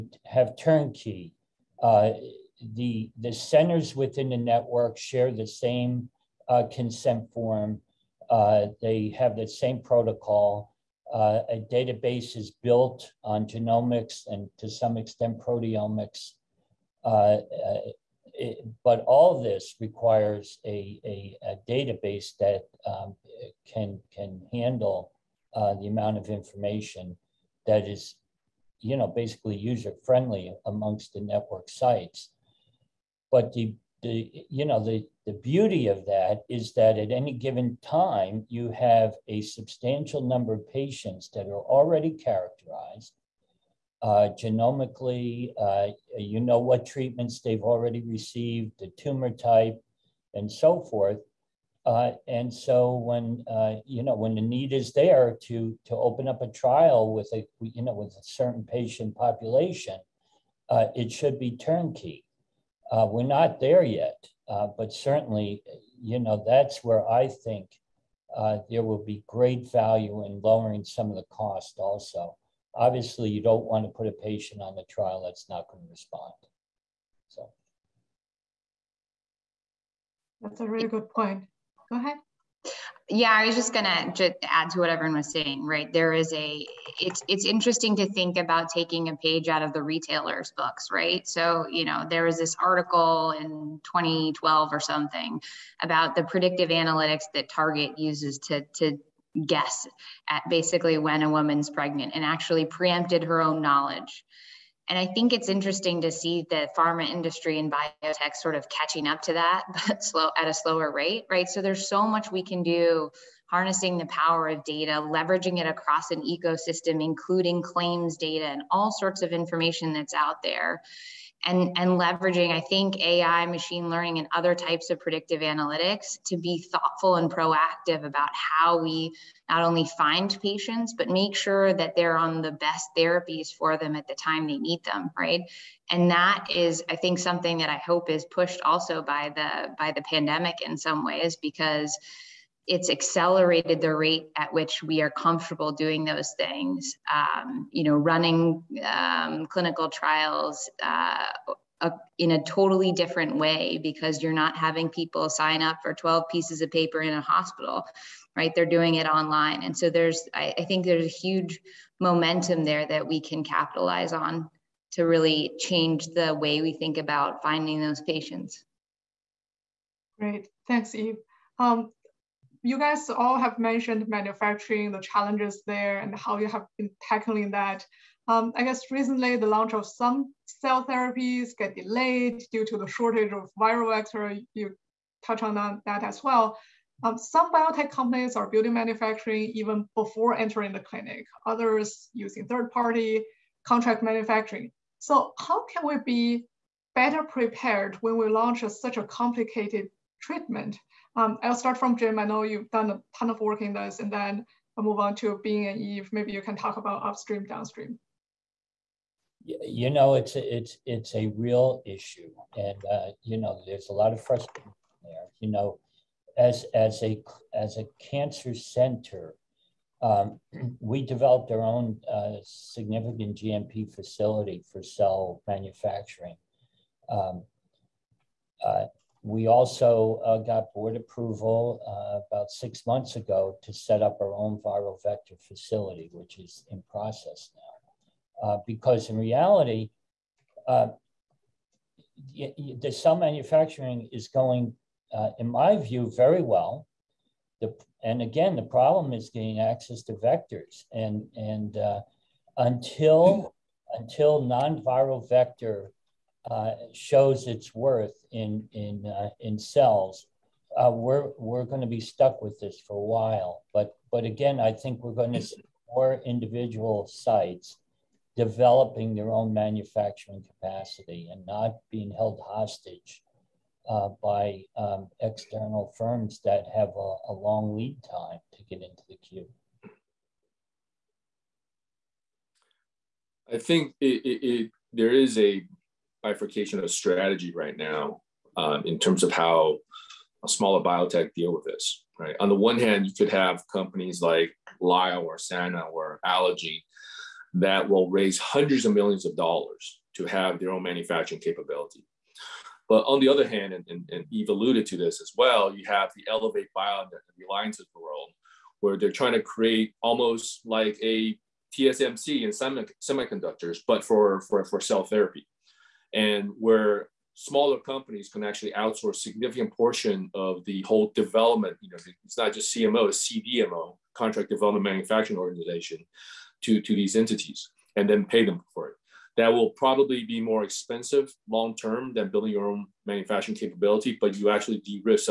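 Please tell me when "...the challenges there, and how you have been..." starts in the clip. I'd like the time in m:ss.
2:54.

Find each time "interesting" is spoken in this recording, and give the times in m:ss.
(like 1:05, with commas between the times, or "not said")
1:27, 1:45.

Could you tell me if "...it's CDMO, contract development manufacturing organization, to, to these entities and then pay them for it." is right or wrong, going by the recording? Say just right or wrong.
right.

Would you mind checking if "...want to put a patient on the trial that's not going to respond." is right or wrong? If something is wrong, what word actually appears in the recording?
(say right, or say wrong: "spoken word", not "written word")
right.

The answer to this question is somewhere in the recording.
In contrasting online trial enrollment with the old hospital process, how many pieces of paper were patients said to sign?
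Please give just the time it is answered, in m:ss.
2:35.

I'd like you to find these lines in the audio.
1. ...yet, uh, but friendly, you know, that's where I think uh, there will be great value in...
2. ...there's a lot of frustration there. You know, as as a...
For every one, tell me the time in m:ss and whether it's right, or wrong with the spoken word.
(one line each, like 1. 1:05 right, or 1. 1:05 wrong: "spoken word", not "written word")
1. 1:03 wrong: "certainly", not "friendly"
2. 3:33 right.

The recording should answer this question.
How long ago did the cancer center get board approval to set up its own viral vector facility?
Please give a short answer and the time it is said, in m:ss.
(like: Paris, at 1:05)
About six months, at 3:52.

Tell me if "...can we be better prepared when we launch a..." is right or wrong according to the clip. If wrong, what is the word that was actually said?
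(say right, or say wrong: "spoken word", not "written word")
right.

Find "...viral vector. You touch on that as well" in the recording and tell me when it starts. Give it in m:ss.
3:03.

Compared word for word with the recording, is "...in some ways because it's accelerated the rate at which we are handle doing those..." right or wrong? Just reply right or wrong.
wrong.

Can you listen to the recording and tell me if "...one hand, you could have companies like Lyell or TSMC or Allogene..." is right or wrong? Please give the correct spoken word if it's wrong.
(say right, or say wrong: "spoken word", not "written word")
wrong: "Sana", not "TSMC".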